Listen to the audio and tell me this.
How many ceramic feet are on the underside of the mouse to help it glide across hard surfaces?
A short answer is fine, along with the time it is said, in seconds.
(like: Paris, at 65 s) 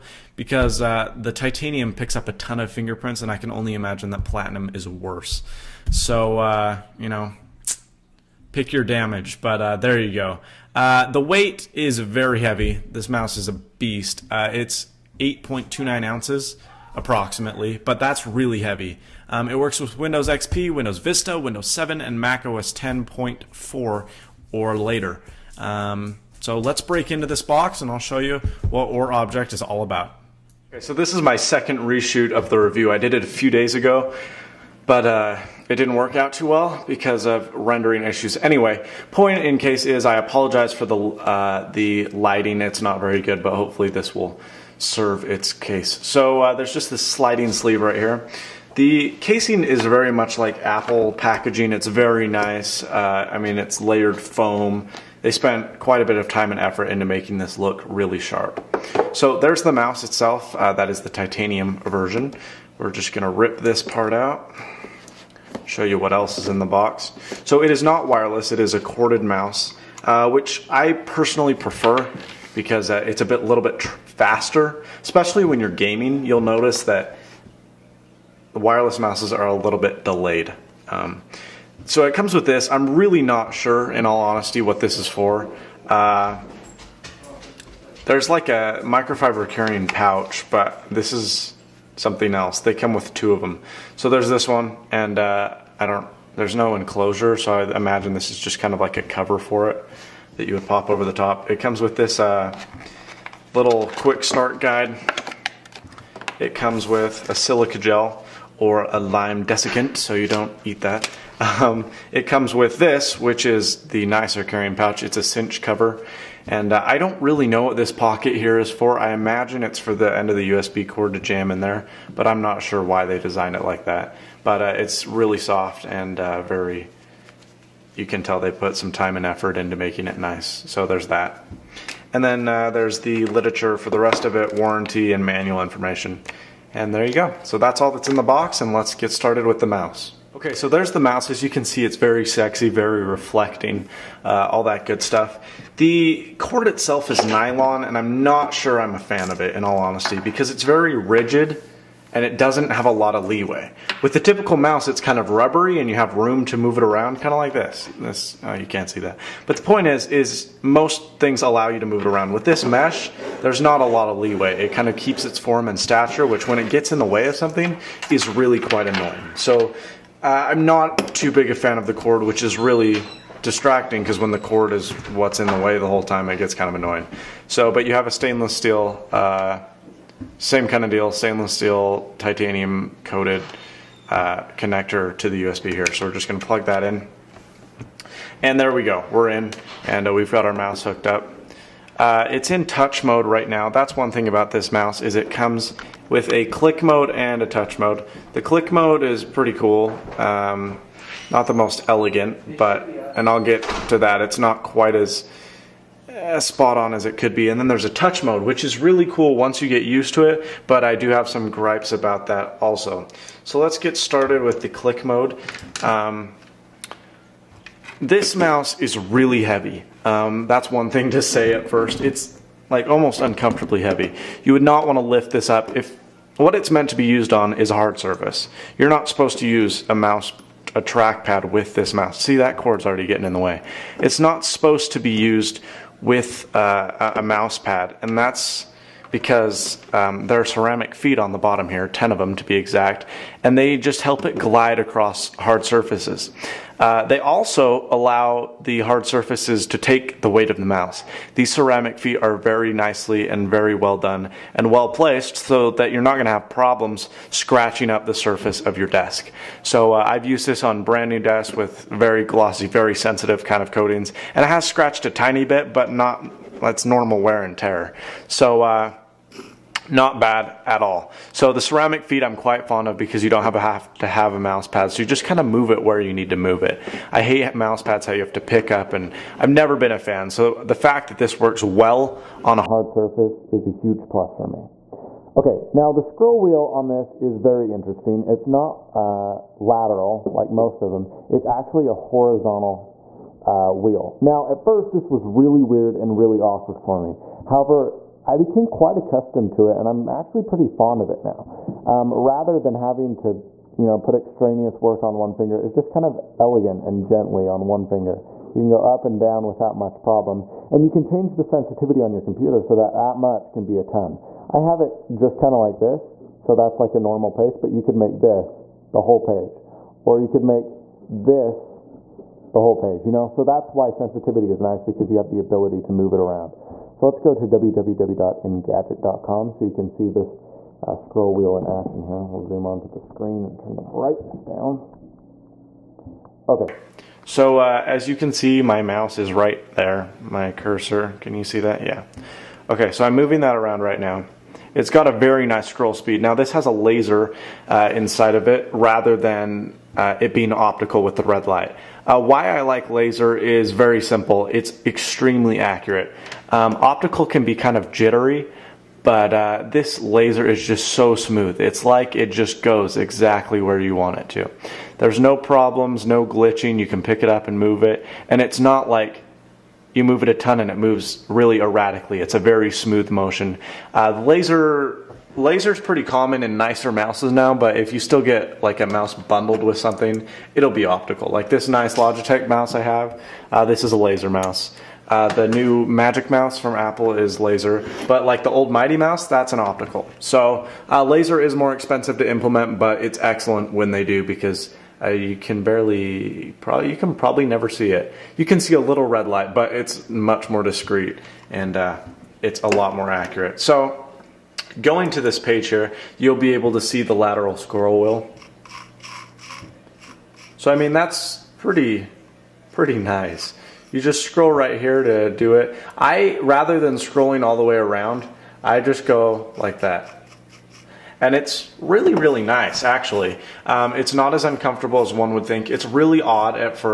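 10, at 241 s.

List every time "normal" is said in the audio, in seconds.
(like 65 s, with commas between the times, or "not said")
266 s, 316 s.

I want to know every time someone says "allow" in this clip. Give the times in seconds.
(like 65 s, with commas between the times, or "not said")
161 s, 247 s.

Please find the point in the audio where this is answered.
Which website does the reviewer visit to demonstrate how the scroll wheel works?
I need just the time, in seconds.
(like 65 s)
327 s.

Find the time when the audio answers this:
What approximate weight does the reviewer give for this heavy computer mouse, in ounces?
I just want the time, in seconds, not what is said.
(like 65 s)
15 s.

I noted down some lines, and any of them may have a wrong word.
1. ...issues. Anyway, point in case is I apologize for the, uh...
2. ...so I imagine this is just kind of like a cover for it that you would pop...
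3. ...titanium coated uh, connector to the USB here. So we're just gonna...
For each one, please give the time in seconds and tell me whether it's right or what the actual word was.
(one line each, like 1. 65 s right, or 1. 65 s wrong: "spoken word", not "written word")
1. 38 s right
2. 97 s right
3. 182 s right.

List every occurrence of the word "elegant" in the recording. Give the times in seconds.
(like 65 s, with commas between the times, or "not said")
201 s, 306 s.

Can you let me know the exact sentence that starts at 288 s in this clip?
It's not uh, lateral like most of them.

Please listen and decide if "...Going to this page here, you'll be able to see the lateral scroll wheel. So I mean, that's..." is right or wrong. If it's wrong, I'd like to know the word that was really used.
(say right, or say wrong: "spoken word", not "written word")
right.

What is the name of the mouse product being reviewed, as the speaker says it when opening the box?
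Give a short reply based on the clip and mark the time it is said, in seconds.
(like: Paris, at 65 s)
OreObject, at 28 s.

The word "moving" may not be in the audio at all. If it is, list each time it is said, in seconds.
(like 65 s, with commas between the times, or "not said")
343 s.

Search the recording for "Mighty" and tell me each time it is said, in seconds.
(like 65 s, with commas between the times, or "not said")
388 s.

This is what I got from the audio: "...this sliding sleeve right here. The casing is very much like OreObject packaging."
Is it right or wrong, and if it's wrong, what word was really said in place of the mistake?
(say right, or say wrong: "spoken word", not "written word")
wrong: "Apple", not "OreObject".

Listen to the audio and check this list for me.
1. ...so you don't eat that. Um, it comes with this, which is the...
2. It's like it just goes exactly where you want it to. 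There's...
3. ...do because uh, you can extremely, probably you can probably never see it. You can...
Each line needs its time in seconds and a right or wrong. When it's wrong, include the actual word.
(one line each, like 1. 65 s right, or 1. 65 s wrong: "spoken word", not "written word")
1. 109 s right
2. 361 s right
3. 394 s wrong: "barely", not "extremely".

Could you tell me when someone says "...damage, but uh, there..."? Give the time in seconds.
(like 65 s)
8 s.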